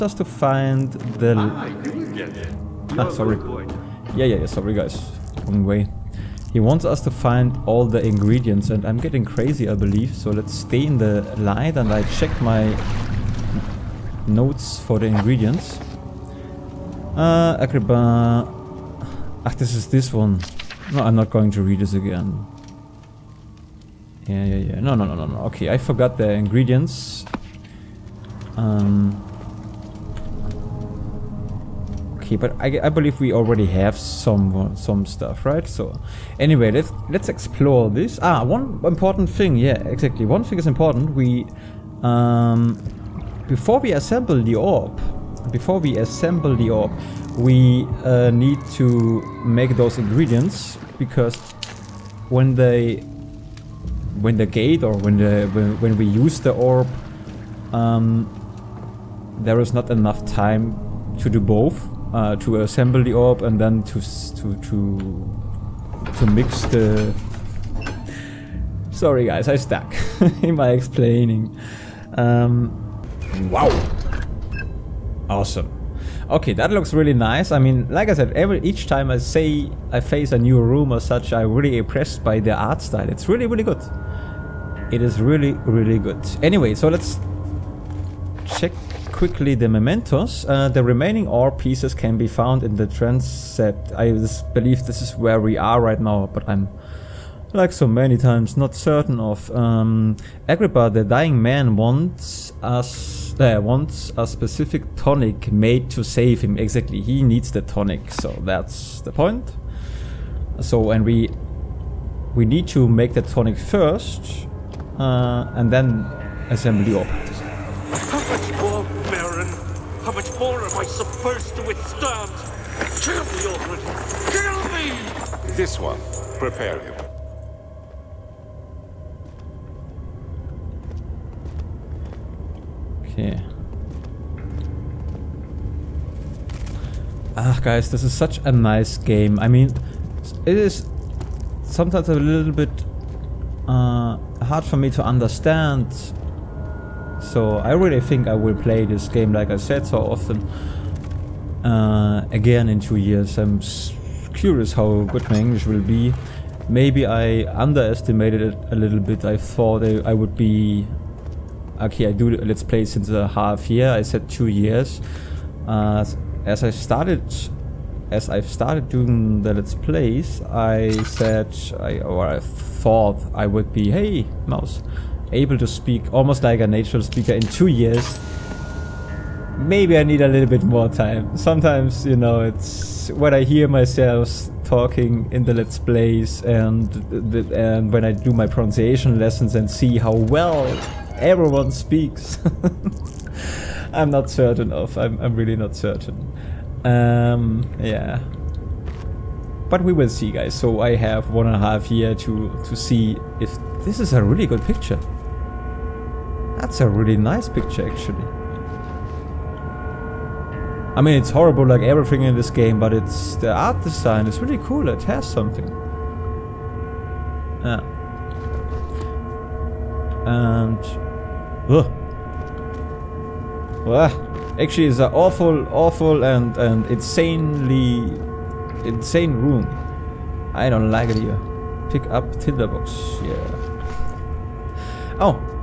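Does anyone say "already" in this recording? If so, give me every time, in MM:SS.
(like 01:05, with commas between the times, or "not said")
00:33, 02:03.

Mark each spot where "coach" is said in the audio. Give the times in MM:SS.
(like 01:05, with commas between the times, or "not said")
not said.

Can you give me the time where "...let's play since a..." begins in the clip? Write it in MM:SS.
02:42.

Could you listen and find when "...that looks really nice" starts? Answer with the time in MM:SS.
01:16.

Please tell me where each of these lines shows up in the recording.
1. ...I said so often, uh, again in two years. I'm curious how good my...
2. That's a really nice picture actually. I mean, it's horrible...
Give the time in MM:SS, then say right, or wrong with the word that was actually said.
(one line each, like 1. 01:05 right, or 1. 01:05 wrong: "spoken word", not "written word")
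1. 02:29 right
2. 03:26 right.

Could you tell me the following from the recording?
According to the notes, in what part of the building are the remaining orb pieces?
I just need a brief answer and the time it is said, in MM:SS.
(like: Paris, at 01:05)
The transept, at 01:32.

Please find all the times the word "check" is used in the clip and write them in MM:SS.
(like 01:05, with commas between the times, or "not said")
00:12, 01:28.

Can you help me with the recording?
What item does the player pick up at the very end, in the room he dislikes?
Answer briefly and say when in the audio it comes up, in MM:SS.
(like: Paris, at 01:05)
Tinderbox, at 03:52.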